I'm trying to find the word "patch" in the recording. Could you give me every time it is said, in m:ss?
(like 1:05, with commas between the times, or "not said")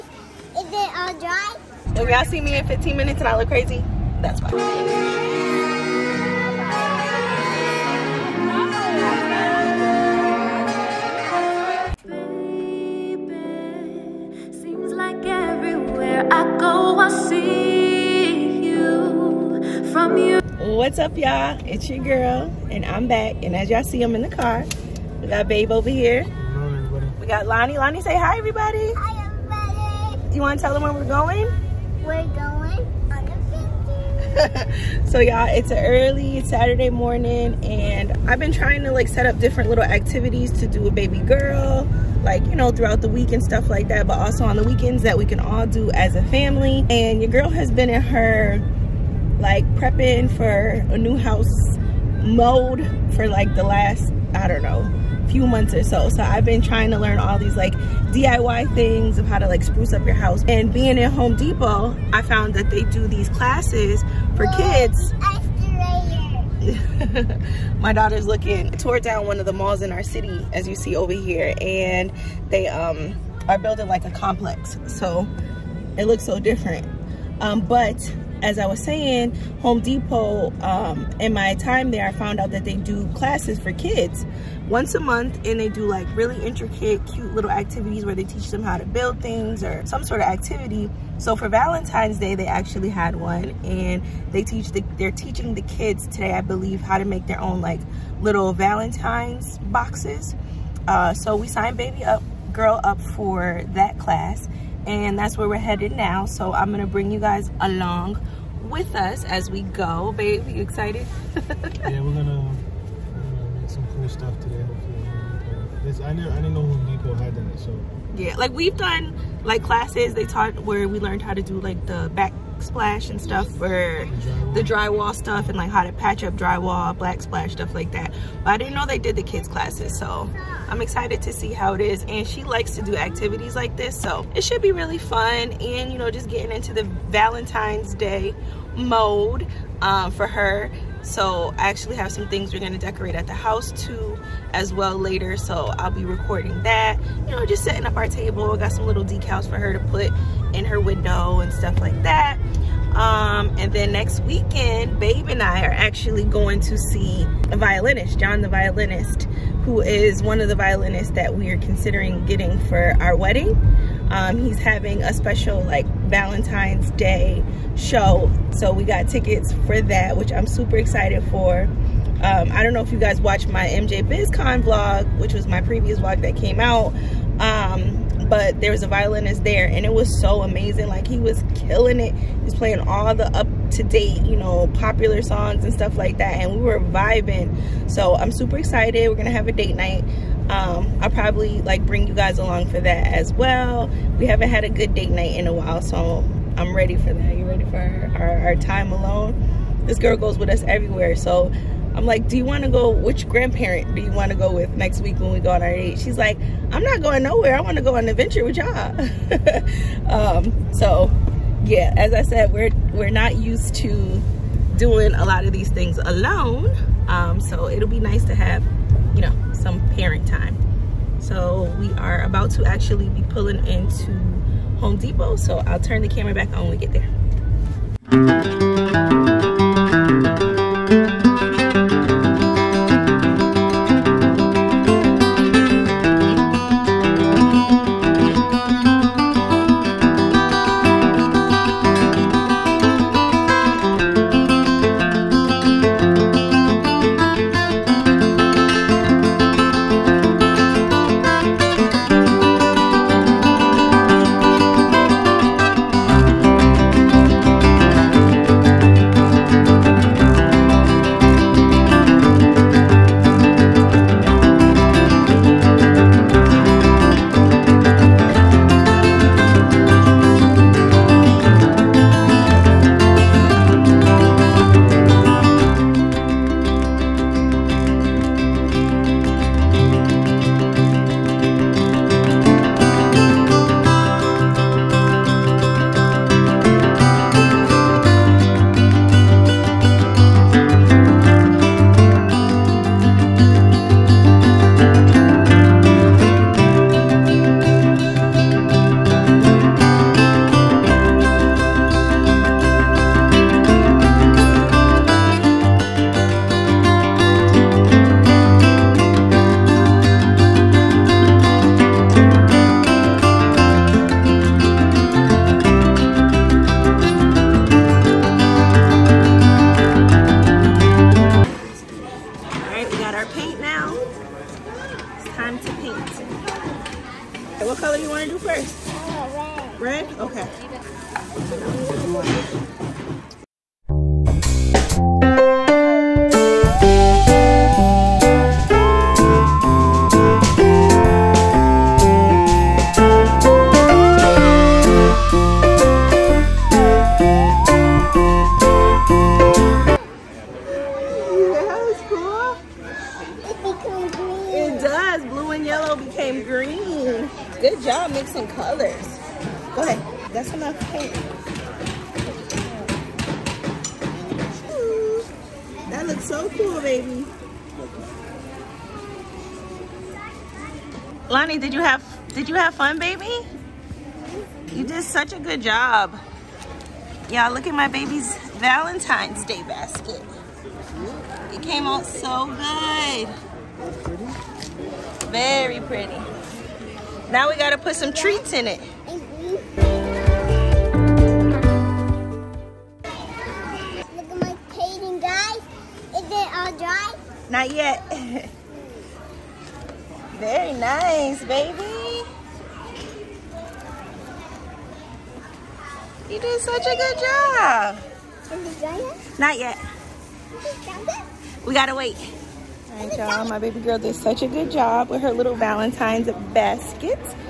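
2:05.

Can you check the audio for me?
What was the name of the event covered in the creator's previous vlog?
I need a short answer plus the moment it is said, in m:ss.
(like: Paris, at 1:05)
MJ BizCon, at 2:53.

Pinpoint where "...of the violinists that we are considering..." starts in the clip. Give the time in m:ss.
2:40.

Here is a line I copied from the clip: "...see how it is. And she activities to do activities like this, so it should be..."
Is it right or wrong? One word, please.
wrong.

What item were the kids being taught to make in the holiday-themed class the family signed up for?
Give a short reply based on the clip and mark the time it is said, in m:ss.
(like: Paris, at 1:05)
Valentine's boxes, at 1:38.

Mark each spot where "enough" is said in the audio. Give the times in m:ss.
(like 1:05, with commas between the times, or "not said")
6:00.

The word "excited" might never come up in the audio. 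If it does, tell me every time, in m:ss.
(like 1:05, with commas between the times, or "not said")
1:50, 2:10, 2:50, 3:08.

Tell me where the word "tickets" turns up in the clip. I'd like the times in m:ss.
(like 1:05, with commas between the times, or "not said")
2:49.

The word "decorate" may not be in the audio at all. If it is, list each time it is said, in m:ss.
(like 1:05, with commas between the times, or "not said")
2:22.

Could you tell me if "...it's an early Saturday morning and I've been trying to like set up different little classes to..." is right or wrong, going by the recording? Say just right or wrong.
wrong.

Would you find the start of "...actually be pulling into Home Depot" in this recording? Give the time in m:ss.
3:42.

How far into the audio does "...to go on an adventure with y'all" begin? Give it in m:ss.
3:27.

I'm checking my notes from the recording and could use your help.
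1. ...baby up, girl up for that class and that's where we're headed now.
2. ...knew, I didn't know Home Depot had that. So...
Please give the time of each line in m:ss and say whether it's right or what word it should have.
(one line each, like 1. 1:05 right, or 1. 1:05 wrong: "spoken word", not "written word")
1. 1:41 right
2. 1:56 right.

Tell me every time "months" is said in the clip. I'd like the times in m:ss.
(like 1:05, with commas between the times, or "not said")
0:55, 1:24.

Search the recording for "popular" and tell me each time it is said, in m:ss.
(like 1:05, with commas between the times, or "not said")
3:04.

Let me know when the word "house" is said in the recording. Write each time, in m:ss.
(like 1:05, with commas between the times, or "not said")
0:51, 1:00, 2:23.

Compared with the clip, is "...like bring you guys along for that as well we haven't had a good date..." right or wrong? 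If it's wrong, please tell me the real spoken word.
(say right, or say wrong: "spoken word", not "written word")
right.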